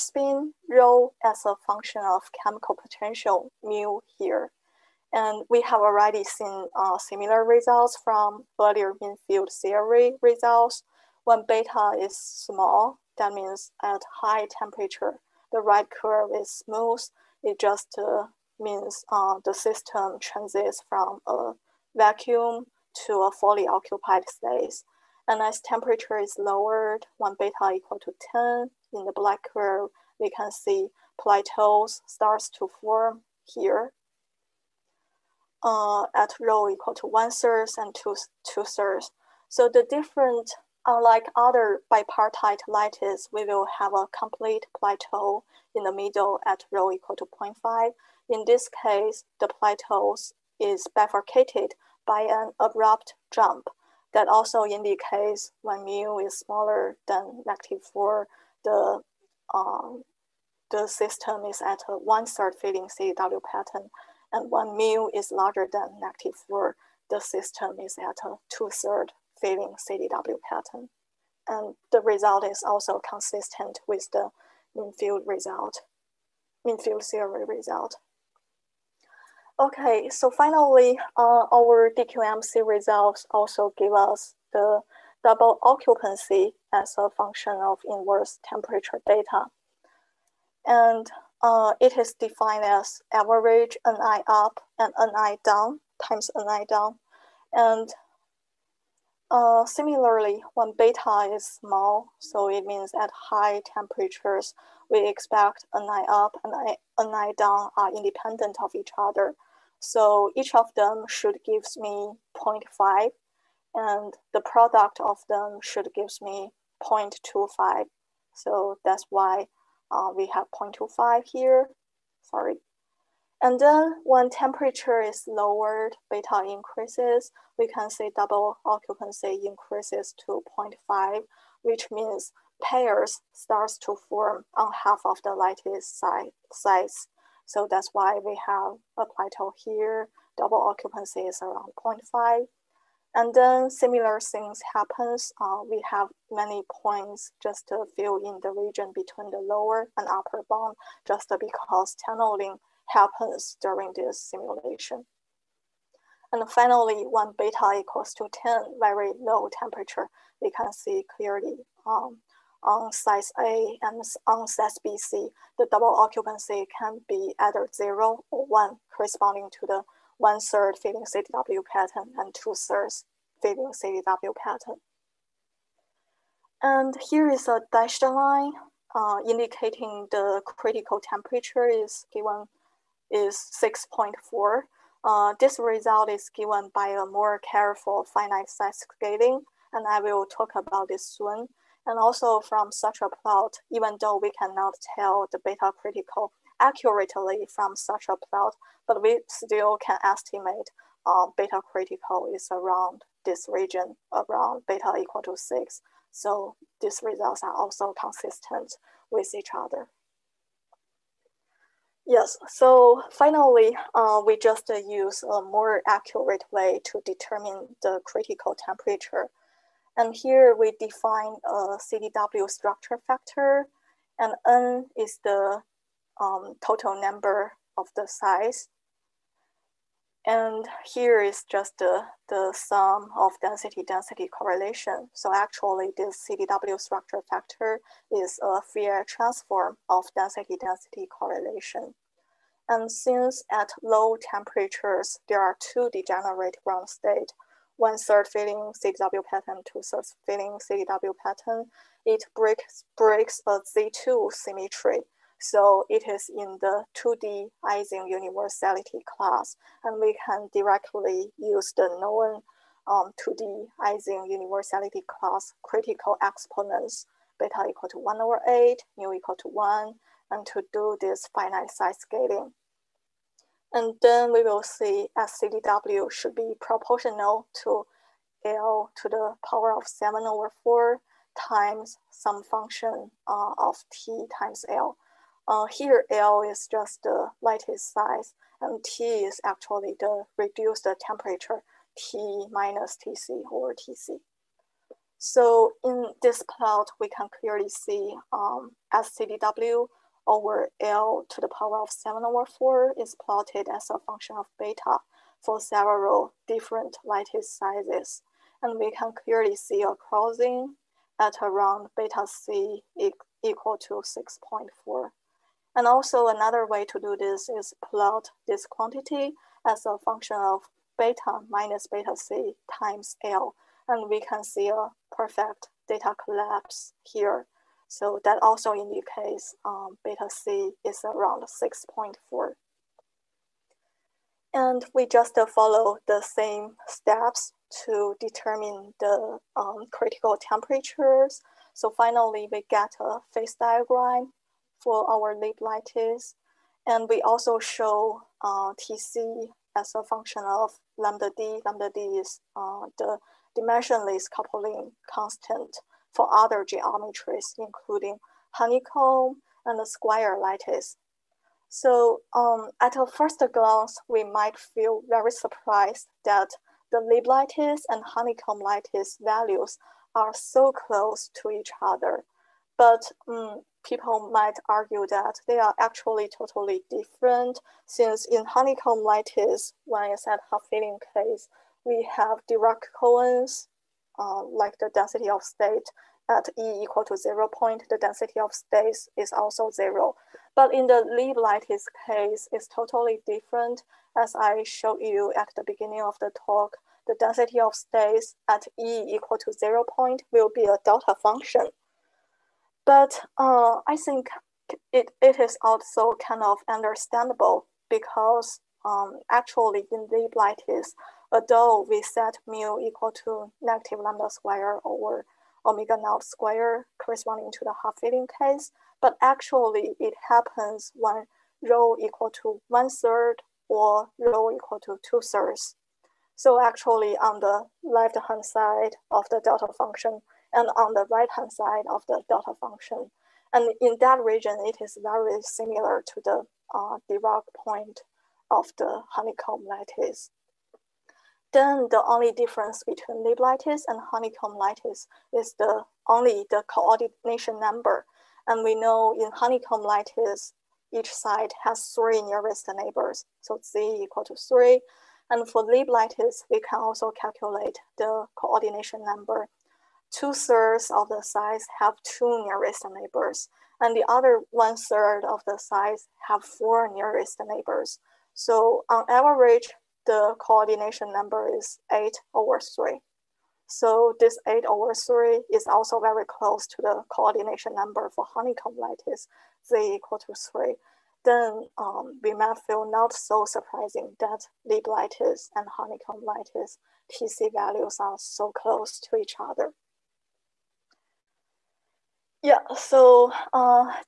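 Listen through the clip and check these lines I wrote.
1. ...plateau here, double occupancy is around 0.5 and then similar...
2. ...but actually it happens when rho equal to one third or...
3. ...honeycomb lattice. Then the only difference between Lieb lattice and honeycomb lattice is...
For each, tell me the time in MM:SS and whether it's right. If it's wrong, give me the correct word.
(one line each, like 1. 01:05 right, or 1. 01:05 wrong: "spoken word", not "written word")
1. 02:19 right
2. 06:59 right
3. 07:19 right.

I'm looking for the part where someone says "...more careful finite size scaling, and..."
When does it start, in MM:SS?
03:07.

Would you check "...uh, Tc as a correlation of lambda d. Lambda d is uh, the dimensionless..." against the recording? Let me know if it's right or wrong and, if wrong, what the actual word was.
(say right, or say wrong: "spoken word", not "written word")
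wrong: "function", not "correlation".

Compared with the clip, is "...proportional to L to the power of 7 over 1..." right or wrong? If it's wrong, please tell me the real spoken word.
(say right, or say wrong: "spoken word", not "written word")
wrong: "4", not "1".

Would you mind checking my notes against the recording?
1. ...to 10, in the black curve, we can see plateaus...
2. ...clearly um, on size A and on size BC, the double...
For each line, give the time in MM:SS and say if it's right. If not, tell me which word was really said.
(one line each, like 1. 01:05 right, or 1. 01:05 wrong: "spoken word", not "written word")
1. 00:27 right
2. 02:41 right.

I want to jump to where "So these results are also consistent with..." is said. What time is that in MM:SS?
03:26.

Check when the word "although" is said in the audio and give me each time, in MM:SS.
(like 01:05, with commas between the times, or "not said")
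06:51.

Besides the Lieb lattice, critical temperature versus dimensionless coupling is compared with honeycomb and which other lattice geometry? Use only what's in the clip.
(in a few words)
square lattice.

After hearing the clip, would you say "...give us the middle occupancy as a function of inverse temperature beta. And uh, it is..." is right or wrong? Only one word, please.
wrong.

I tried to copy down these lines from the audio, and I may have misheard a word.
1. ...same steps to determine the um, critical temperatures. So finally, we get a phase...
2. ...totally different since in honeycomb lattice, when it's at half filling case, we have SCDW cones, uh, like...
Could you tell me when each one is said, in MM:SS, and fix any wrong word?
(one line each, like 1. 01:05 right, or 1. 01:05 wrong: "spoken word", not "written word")
1. 05:36 right
2. 06:16 wrong: "Dirac", not "SCDW".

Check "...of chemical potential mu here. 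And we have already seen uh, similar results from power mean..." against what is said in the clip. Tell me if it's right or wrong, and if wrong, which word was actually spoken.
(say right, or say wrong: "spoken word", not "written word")
wrong: "earlier", not "power".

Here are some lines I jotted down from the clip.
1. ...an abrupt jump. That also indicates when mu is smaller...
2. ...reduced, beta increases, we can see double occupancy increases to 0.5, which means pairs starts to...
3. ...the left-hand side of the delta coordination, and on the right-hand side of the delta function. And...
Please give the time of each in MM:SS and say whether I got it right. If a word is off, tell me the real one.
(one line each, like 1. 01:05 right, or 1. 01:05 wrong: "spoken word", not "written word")
1. 00:52 right
2. 02:05 wrong: "lowered", not "reduced"
3. 07:07 wrong: "function", not "coordination".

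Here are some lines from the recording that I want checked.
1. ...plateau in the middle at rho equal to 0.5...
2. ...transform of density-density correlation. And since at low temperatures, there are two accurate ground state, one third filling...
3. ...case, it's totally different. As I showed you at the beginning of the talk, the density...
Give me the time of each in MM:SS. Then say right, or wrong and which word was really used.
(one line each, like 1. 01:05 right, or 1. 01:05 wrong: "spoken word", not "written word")
1. 00:44 right
2. 03:59 wrong: "degenerate", not "accurate"
3. 06:32 right.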